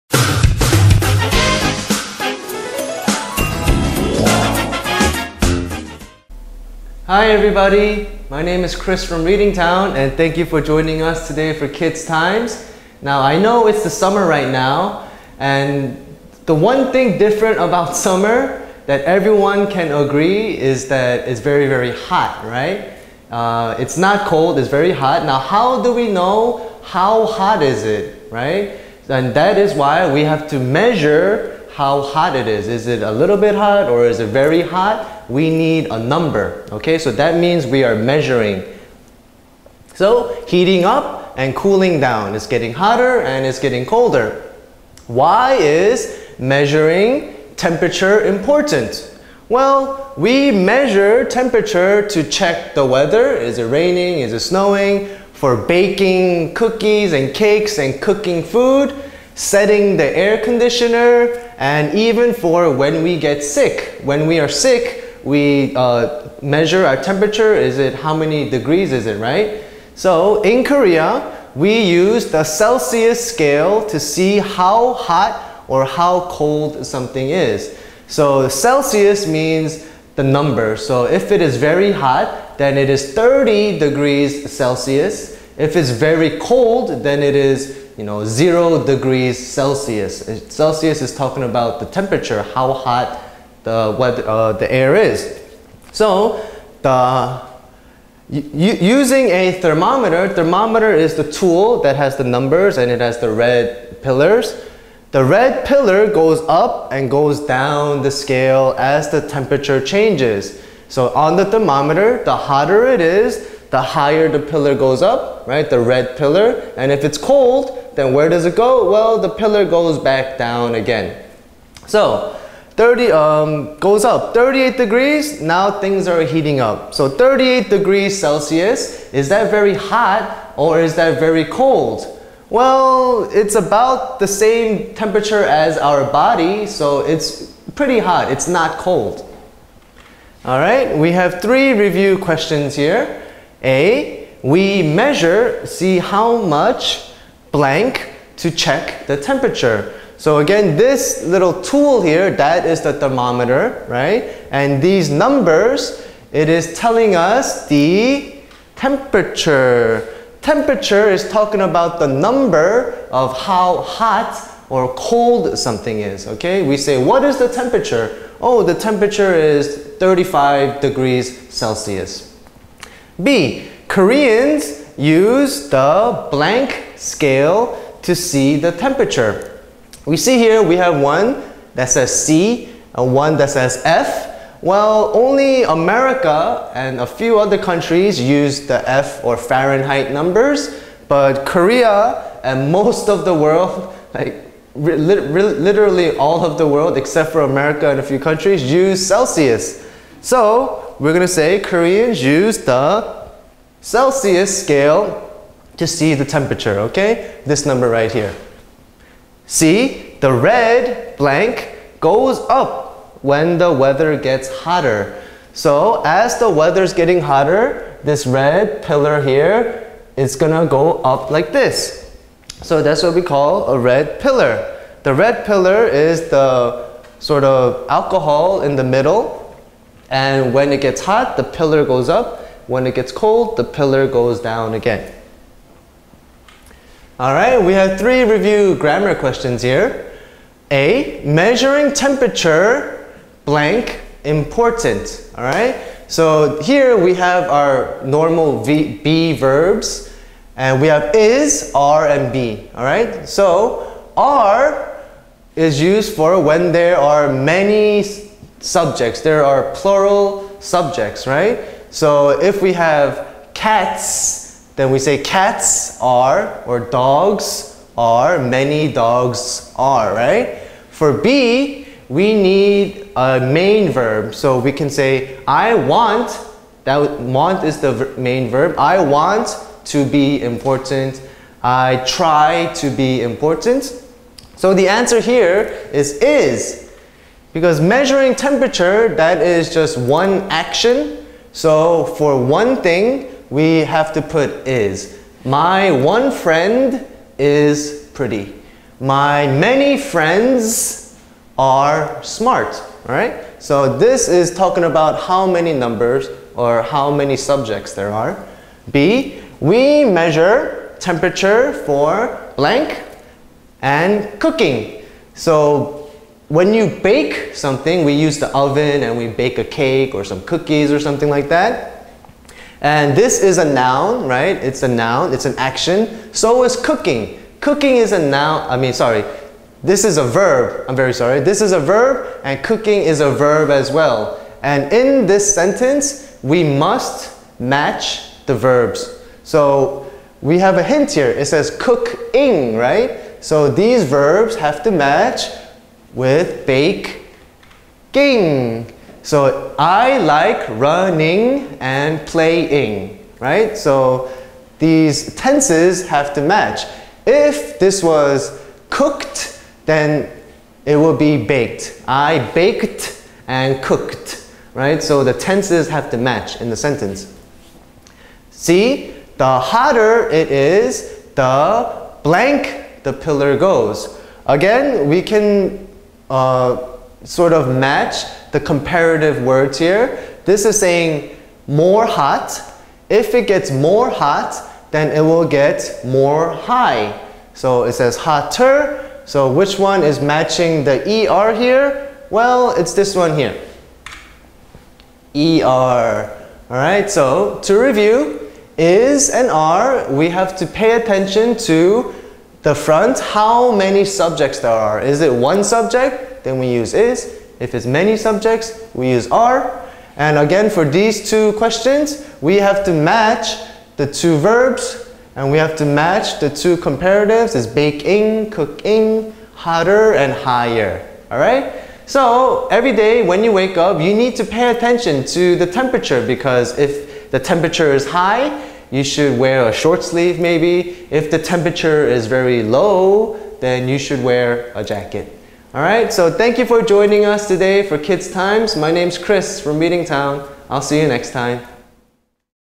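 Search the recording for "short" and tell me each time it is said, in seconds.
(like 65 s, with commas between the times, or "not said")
429 s.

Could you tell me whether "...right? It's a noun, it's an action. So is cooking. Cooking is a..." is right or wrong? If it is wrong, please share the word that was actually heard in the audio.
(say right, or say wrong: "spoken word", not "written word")
right.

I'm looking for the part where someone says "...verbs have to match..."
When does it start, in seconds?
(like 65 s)
344 s.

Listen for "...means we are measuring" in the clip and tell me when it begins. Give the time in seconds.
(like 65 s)
37 s.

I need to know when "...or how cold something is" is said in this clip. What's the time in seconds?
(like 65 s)
75 s.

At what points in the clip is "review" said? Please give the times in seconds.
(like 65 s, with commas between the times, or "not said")
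141 s, 238 s, 397 s.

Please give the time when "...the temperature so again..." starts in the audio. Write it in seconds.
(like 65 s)
149 s.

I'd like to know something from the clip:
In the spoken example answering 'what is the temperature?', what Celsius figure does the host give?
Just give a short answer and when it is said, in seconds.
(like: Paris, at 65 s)
35 degrees, at 169 s.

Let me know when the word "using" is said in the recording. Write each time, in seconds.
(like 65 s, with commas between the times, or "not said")
98 s.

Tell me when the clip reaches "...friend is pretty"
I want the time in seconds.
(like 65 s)
296 s.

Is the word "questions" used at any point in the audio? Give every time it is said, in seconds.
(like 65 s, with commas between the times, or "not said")
142 s, 239 s, 411 s.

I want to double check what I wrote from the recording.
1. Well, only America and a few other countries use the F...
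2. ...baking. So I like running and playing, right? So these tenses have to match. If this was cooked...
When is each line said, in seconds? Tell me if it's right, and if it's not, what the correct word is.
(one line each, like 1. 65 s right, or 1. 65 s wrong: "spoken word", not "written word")
1. 184 s right
2. 348 s right.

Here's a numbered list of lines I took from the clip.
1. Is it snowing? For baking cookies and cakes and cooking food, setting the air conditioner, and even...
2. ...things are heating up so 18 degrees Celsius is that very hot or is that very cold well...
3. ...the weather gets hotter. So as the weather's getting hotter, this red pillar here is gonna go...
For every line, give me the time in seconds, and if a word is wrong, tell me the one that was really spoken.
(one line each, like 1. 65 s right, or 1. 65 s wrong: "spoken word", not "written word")
1. 54 s right
2. 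125 s wrong: "38", not "18"
3. 213 s right.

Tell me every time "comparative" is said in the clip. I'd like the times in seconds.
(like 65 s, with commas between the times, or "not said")
378 s, 416 s.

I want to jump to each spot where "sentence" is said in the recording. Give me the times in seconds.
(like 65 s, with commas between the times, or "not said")
335 s, 366 s.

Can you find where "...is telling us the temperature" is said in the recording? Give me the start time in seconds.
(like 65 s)
156 s.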